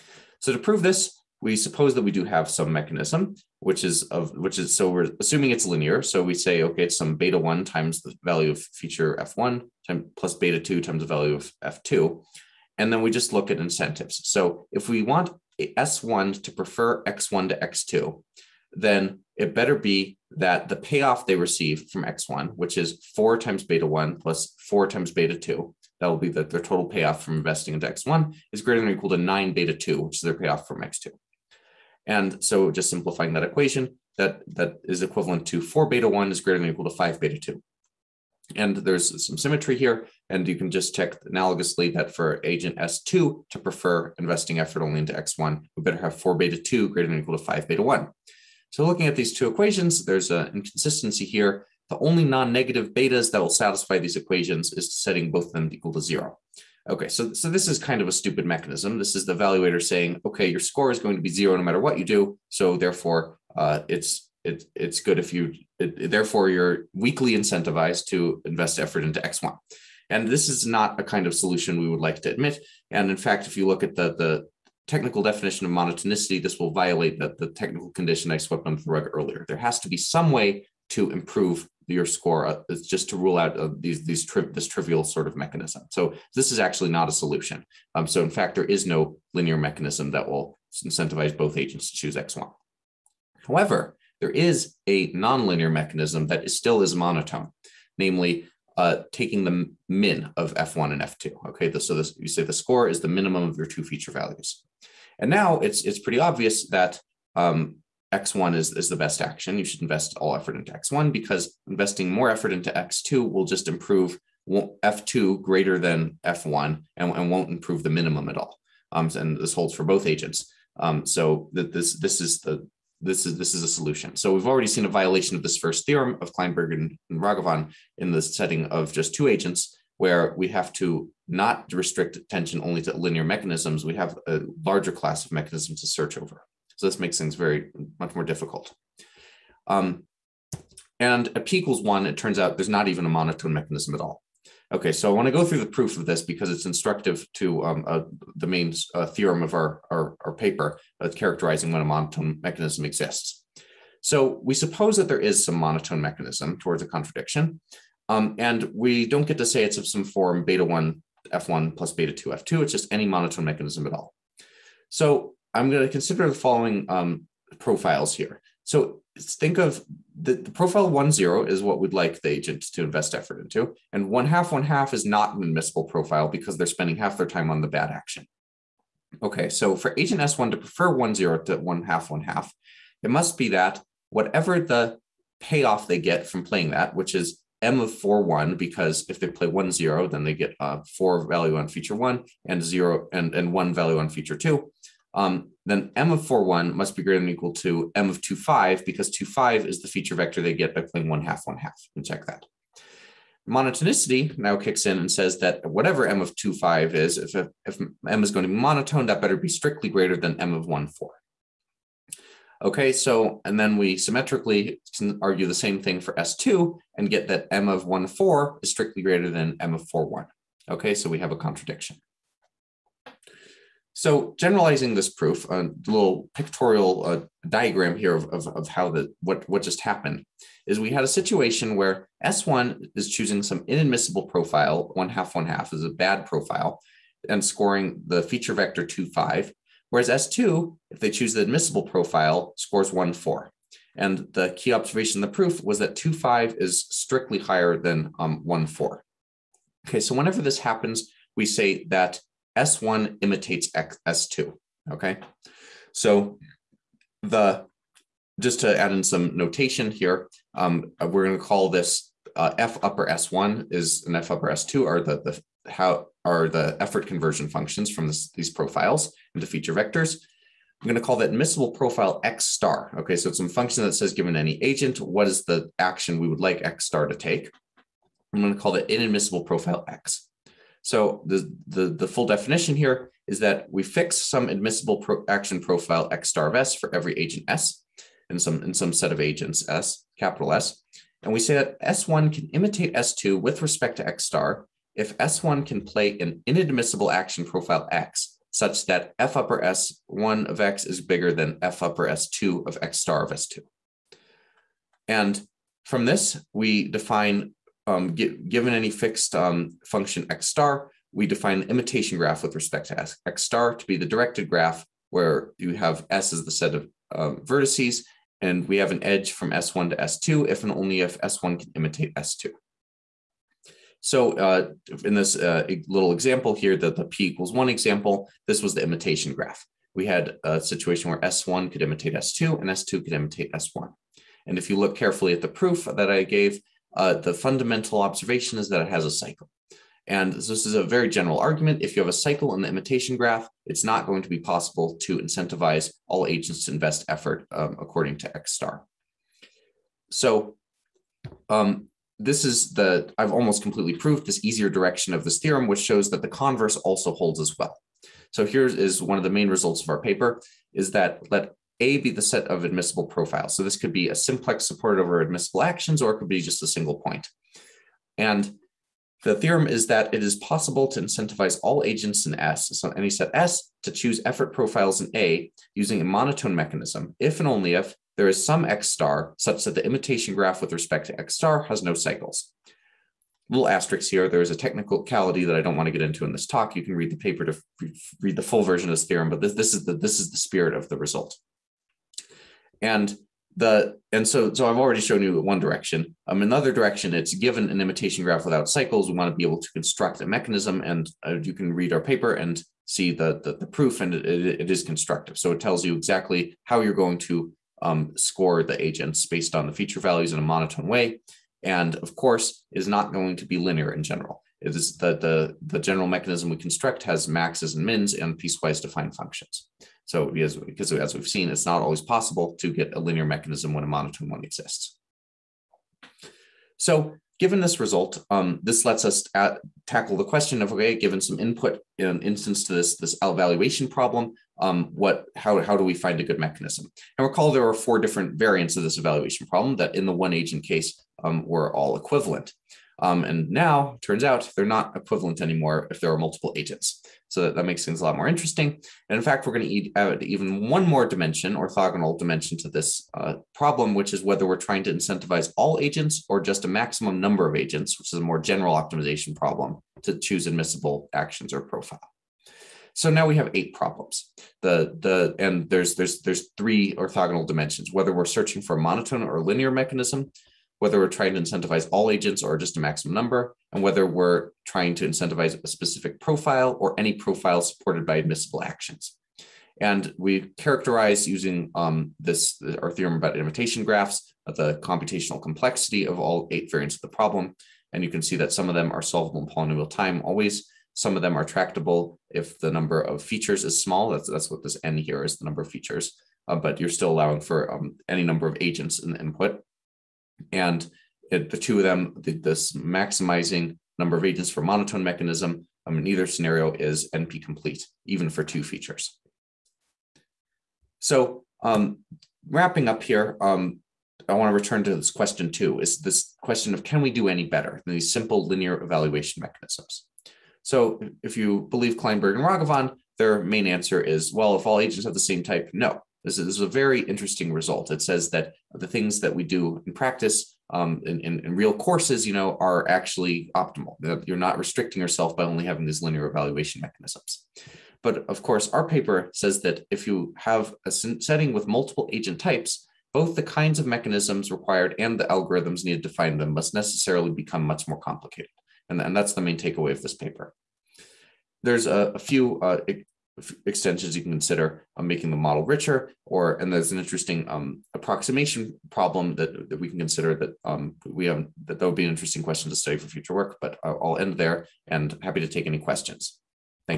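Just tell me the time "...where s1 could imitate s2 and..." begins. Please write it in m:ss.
5:31.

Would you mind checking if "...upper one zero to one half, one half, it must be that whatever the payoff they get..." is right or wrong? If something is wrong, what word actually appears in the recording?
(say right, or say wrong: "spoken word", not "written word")
wrong: "prefer", not "upper".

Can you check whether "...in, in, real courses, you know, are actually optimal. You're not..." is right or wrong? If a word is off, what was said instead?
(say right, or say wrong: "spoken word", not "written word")
right.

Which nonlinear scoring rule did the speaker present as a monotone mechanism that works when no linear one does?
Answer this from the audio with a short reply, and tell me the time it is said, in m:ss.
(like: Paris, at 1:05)
the min of F1 and F2, at 1:39.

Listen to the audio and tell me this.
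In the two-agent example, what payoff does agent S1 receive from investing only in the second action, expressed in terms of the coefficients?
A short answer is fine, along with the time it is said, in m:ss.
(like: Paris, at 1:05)
9 beta 2, at 0:29.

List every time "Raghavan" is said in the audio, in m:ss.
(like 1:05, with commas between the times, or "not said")
2:07, 8:42.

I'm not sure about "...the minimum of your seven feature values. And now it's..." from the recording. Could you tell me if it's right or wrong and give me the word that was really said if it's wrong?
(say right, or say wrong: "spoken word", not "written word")
wrong: "two", not "seven".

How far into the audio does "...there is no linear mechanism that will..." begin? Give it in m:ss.
1:28.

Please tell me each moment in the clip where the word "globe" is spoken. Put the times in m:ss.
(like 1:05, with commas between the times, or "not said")
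not said.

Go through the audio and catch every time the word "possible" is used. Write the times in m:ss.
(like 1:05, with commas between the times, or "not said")
5:44, 6:10, 7:02.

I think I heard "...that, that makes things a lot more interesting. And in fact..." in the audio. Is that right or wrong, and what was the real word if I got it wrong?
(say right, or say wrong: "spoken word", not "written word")
right.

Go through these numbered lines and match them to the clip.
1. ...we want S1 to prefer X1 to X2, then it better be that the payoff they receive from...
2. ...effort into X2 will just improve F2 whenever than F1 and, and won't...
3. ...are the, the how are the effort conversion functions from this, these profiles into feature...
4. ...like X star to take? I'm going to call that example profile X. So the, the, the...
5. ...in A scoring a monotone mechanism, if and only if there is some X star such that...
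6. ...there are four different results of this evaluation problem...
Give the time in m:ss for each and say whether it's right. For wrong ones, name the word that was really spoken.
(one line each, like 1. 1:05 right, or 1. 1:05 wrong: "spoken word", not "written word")
1. 0:14 right
2. 1:52 wrong: "greater", not "whenever"
3. 4:24 right
4. 4:36 wrong: "inadmissible", not "example"
5. 6:15 wrong: "using", not "scoring"
6. 7:17 wrong: "variants", not "results".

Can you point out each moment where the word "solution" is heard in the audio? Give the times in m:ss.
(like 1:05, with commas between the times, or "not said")
1:11, 1:27, 2:03.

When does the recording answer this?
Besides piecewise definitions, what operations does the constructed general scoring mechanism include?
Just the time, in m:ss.
6:57.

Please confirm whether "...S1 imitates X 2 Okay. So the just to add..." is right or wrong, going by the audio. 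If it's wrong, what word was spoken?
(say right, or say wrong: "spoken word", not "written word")
right.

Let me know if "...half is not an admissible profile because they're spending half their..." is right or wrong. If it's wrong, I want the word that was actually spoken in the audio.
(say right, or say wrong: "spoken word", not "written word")
right.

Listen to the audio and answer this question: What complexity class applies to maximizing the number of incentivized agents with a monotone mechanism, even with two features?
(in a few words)
NP complete.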